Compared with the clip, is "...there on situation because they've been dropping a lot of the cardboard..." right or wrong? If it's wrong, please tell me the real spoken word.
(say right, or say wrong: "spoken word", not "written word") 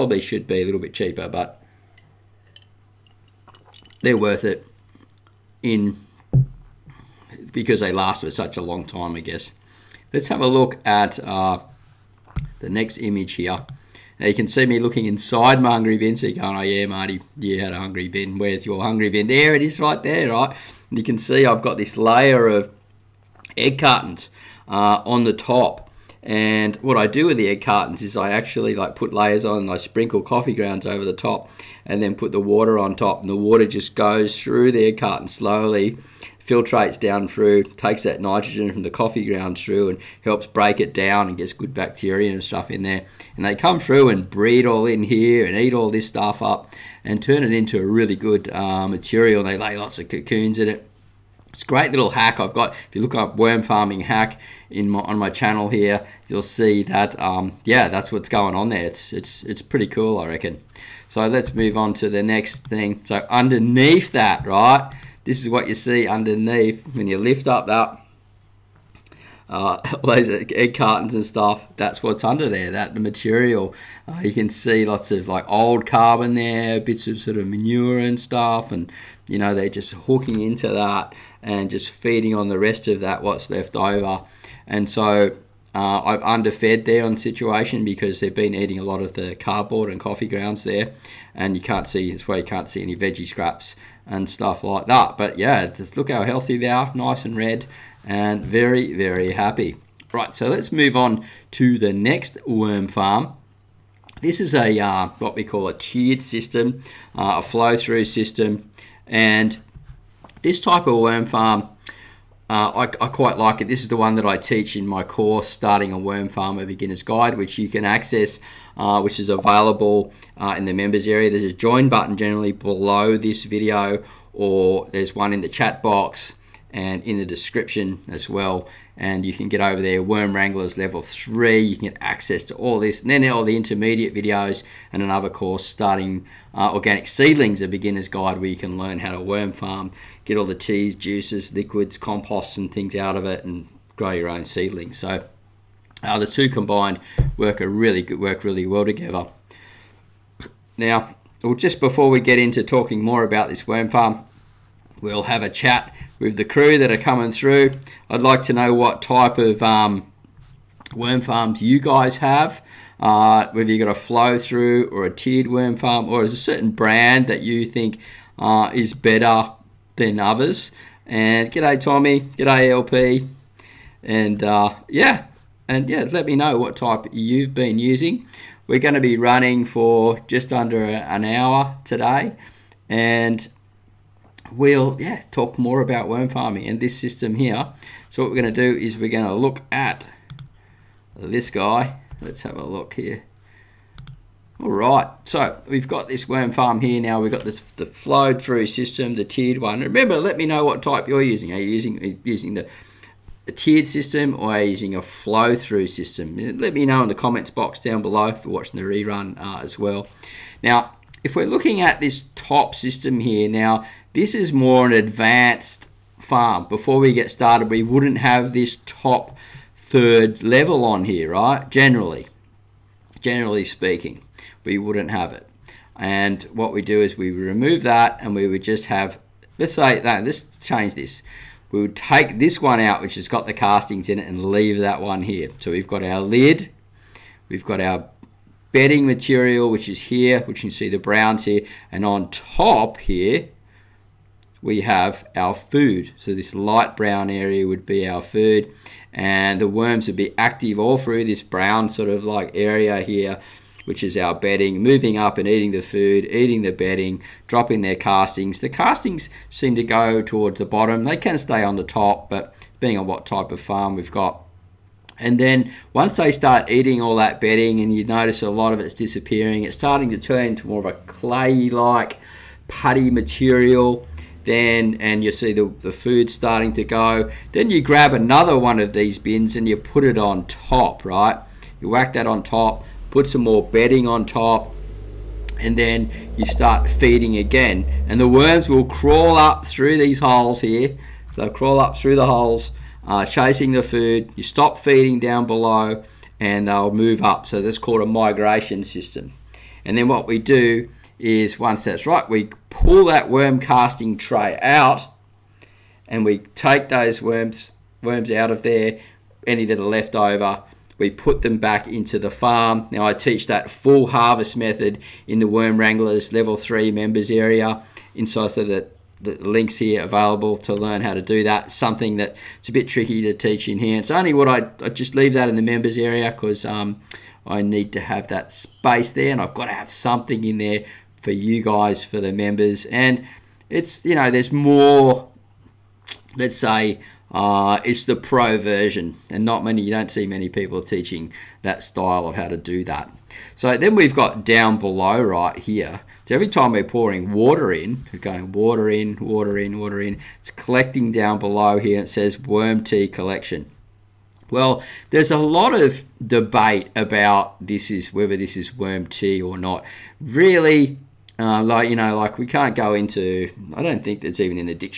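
wrong: "eating", not "dropping".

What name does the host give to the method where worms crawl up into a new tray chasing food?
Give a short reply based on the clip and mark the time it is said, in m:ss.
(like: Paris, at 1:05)
Migration system, at 4:58.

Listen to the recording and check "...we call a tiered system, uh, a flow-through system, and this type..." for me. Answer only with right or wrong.
right.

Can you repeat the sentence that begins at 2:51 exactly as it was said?
And g'day Tommy, g'day LP, and uh, yeah, and yeah, let me know what type you've been using.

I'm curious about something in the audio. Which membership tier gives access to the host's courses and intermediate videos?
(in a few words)
Worm Wranglers Level 3.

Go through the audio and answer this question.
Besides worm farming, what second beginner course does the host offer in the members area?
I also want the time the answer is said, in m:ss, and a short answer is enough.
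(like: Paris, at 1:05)
Organic Seedlings, at 2:16.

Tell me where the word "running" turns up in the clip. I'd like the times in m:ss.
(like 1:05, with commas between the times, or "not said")
2:59.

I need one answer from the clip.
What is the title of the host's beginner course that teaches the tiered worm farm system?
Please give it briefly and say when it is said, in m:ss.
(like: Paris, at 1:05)
Starting a Worm Farm A Beginner's Guide, at 1:55.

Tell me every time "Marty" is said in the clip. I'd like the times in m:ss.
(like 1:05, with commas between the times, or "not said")
0:16.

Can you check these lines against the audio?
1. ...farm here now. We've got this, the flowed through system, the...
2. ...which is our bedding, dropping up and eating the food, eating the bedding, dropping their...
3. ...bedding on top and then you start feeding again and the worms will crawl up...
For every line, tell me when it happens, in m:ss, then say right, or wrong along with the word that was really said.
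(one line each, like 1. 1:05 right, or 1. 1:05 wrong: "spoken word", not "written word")
1. 3:16 right
2. 4:13 wrong: "moving", not "dropping"
3. 4:43 right.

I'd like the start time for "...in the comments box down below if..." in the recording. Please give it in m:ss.
3:27.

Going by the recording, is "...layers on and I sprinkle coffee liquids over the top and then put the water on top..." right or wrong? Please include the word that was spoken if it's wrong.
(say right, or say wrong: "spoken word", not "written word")
wrong: "grounds", not "liquids".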